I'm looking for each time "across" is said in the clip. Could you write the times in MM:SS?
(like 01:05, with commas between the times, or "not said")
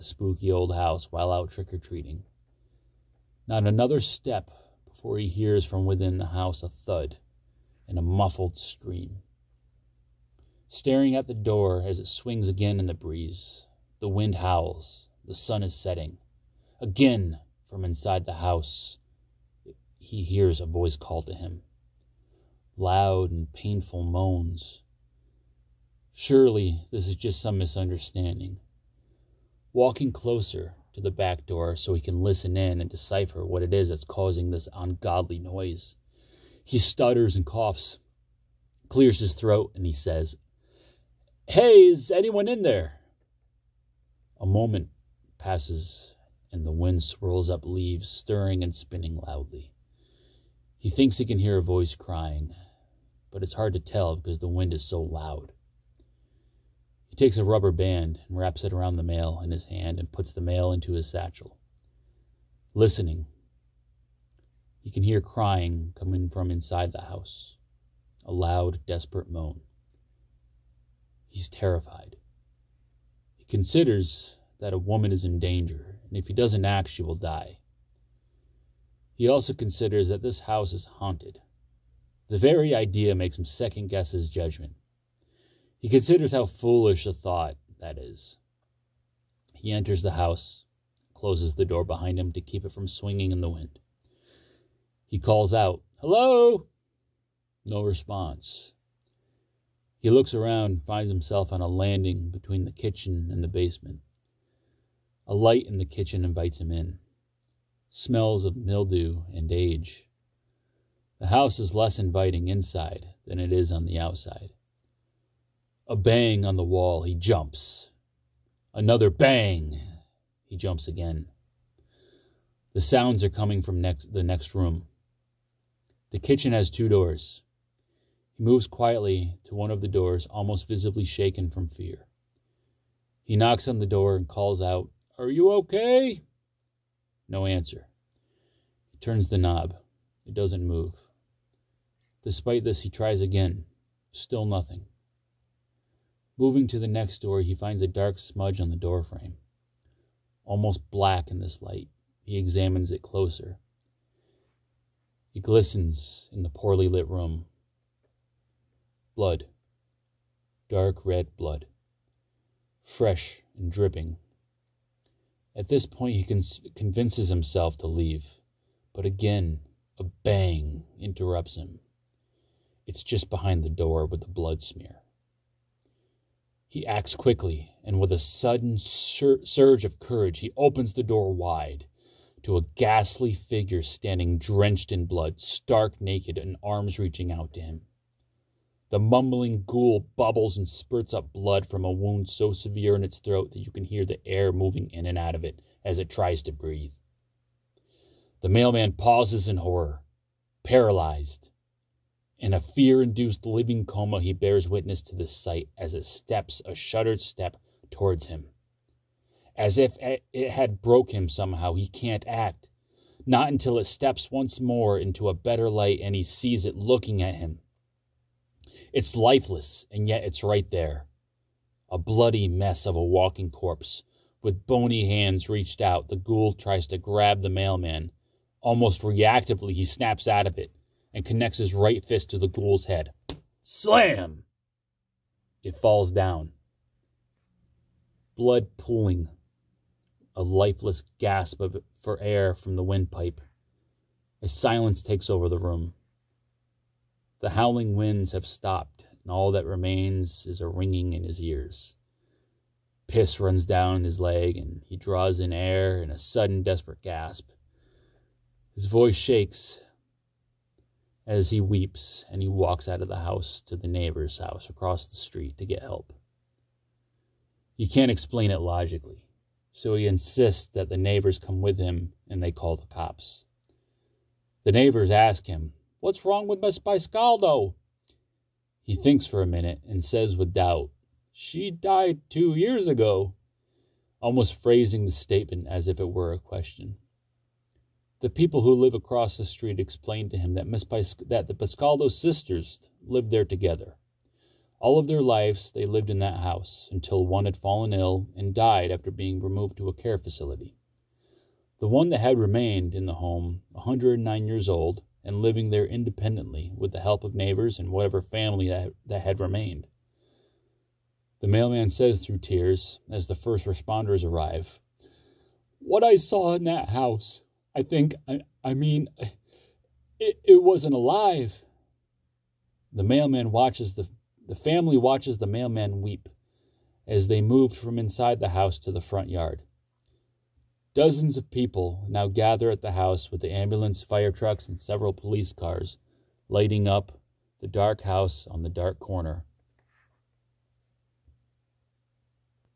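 04:24, 04:48.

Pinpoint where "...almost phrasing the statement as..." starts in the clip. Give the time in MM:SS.
04:44.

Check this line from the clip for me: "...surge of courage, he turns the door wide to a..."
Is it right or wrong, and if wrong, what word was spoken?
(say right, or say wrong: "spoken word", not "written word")
wrong: "opens", not "turns".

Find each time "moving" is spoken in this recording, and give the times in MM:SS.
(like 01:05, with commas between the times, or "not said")
02:26, 03:14.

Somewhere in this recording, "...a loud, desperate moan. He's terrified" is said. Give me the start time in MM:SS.
01:08.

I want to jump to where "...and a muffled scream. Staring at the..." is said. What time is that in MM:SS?
00:07.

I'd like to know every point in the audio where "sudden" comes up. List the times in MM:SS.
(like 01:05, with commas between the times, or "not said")
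02:58, 04:16.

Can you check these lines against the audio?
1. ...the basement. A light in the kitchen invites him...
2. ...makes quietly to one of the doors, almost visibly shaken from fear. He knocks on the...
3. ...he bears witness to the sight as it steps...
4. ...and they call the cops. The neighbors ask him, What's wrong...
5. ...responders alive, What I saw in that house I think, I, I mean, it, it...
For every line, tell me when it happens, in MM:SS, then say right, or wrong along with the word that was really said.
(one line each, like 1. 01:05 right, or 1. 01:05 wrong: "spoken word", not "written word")
1. 01:43 right
2. 02:08 wrong: "moves", not "makes"
3. 03:24 right
4. 04:32 right
5. 05:13 wrong: "arrive", not "alive".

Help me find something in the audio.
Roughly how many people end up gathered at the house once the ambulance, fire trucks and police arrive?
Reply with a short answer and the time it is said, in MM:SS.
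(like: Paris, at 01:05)
Dozens, at 05:30.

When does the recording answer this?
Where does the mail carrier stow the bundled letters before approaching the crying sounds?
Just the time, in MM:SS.
01:01.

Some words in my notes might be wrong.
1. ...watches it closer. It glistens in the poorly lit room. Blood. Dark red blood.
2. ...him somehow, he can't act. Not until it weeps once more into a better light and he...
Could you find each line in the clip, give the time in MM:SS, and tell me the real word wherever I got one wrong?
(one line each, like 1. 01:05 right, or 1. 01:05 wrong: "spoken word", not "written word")
1. 02:32 wrong: "examines", not "watches"
2. 03:31 wrong: "steps", not "weeps".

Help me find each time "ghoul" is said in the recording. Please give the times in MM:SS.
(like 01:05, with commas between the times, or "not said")
03:09, 03:46, 03:52.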